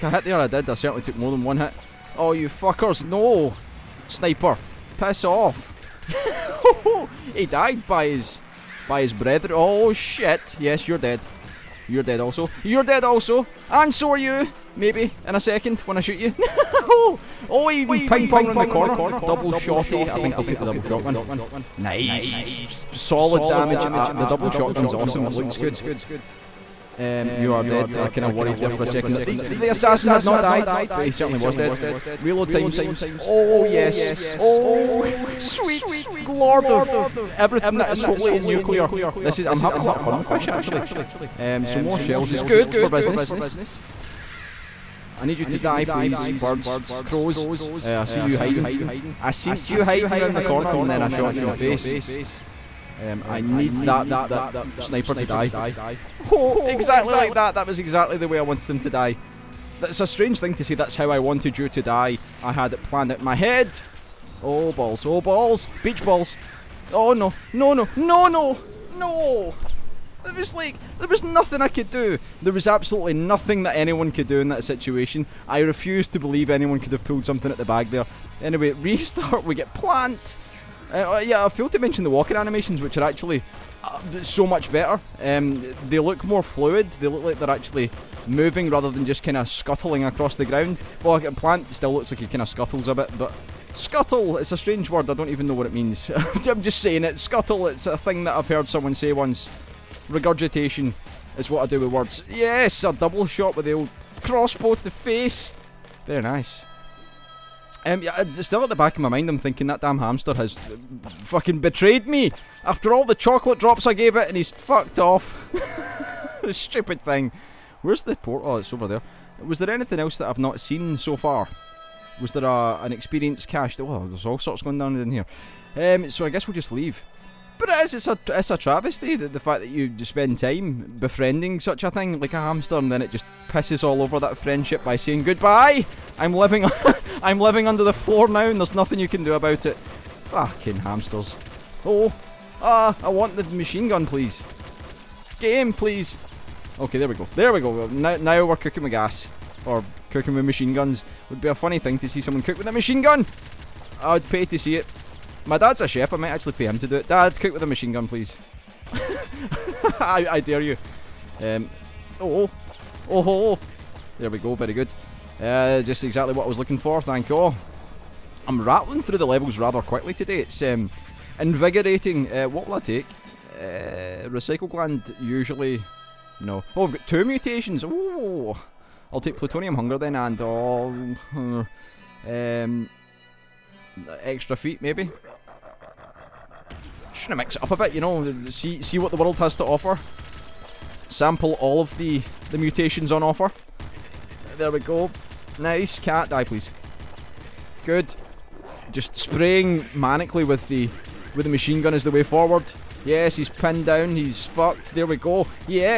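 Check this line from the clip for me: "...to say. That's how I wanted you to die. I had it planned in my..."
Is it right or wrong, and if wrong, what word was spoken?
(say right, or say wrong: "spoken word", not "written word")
right.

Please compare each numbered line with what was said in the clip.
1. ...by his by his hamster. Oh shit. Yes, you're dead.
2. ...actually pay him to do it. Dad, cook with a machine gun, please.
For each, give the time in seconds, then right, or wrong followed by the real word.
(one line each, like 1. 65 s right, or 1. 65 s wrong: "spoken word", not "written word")
1. 7 s wrong: "brother", not "hamster"
2. 156 s right.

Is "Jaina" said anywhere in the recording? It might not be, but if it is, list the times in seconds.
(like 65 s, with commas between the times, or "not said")
not said.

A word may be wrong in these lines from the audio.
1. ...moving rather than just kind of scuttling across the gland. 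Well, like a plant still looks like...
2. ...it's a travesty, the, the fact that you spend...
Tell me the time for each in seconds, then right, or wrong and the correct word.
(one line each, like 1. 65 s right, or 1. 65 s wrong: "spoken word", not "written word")
1. 88 s wrong: "ground", not "gland"
2. 128 s right.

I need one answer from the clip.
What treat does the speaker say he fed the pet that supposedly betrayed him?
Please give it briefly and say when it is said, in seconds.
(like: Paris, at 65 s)
Chocolate drops, at 113 s.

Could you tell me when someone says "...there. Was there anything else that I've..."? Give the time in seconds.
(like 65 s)
118 s.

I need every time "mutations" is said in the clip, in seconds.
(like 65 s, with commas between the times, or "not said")
177 s, 192 s.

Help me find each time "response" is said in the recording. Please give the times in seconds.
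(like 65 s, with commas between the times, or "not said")
not said.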